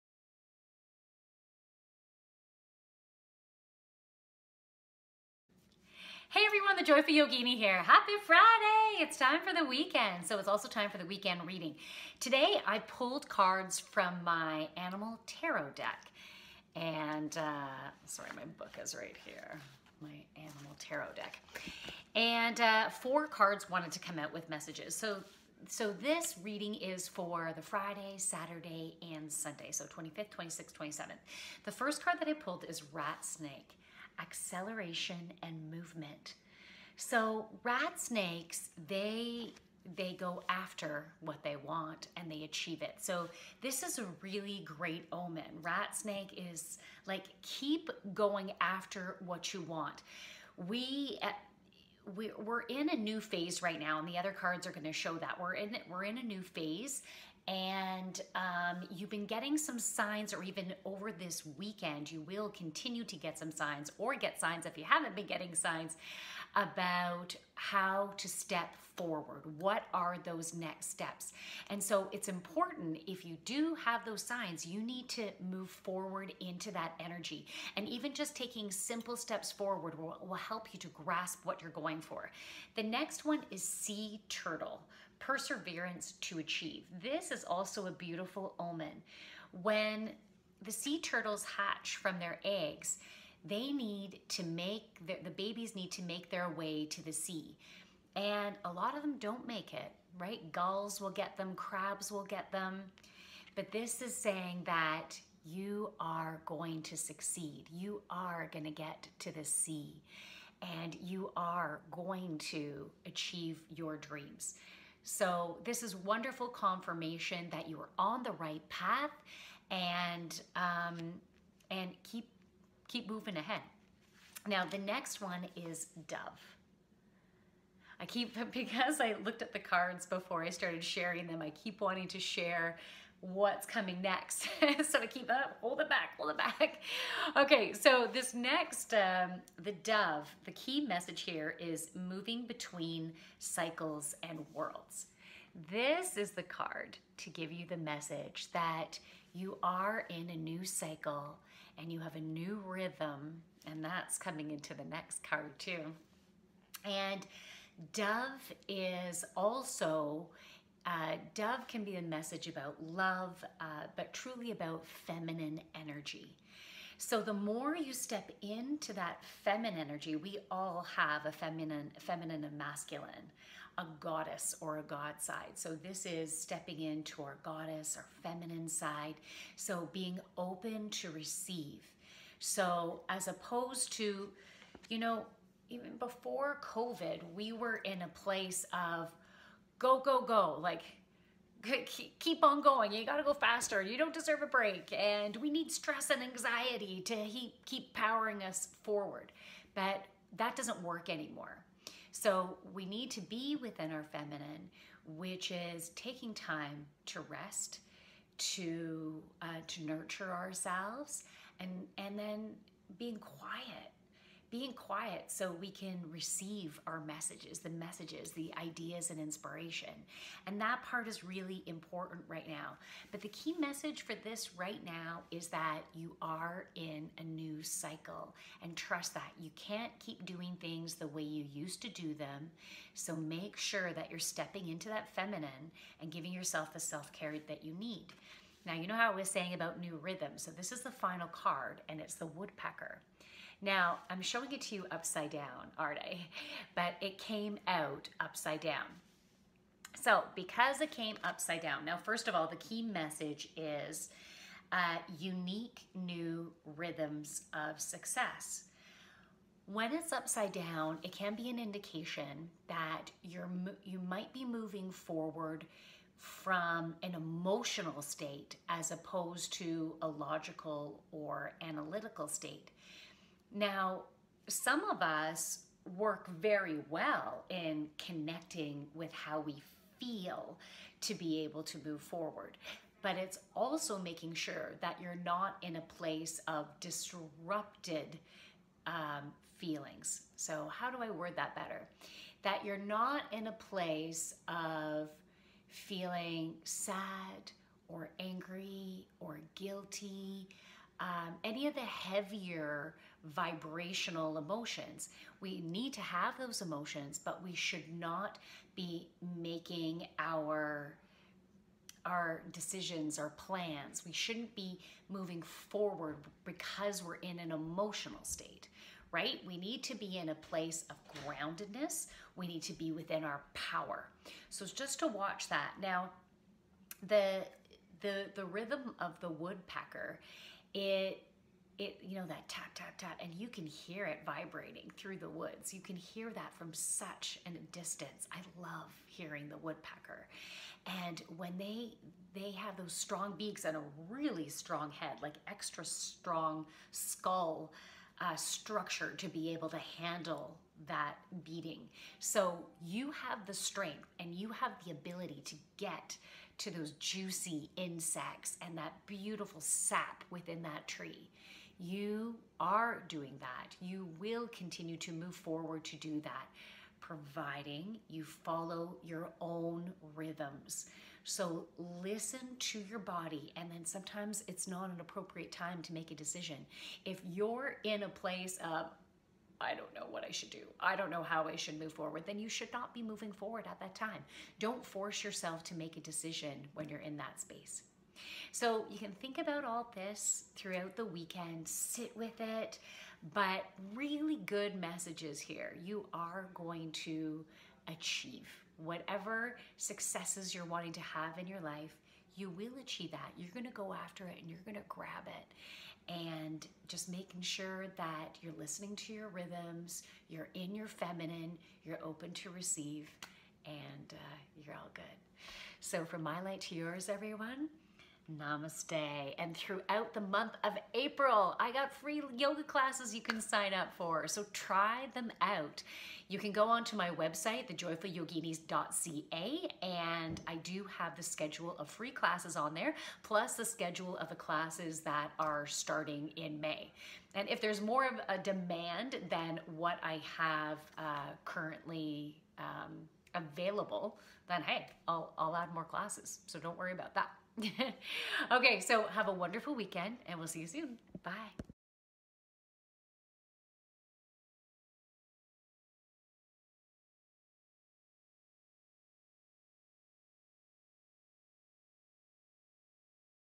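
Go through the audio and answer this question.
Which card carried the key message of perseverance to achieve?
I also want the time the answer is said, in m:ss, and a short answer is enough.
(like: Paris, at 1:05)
Sea turtle, at 1:23.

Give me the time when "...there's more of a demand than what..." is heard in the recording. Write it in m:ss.
7:17.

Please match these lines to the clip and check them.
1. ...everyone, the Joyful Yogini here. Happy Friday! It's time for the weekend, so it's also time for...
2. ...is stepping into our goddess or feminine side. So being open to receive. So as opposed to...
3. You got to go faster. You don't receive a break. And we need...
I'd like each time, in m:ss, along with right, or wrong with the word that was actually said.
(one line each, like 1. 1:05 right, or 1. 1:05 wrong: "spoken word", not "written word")
1. 0:06 right
2. 2:56 right
3. 3:12 wrong: "deserve", not "receive".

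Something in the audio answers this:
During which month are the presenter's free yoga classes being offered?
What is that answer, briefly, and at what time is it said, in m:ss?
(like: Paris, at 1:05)
April, at 7:00.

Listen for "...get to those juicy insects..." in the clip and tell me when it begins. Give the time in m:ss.
5:55.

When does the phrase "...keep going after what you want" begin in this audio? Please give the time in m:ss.
0:47.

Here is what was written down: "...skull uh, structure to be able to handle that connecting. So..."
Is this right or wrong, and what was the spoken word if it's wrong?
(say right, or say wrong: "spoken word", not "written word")
wrong: "beating", not "connecting".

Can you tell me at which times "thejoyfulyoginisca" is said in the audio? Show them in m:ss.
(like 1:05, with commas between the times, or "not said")
7:07.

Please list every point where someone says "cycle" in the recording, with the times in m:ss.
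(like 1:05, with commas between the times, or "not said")
2:23, 2:30, 3:47.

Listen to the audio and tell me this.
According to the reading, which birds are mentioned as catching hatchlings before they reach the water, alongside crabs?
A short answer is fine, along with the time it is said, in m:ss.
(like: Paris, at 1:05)
Gulls, at 1:40.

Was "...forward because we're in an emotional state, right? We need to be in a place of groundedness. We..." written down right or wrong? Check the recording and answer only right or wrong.
right.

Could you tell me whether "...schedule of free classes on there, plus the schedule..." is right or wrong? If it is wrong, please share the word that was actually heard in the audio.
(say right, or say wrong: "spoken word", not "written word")
right.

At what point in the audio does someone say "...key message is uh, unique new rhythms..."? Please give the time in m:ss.
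4:12.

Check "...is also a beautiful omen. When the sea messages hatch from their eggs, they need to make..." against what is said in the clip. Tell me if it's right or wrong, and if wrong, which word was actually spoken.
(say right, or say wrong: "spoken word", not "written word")
wrong: "turtles", not "messages".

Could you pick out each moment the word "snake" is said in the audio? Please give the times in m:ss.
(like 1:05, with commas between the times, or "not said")
0:33, 0:37, 0:45.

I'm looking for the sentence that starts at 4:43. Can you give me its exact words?
But it's also making sure that you're not in a place of disrupted um, feelings.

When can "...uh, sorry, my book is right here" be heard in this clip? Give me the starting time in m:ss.
0:17.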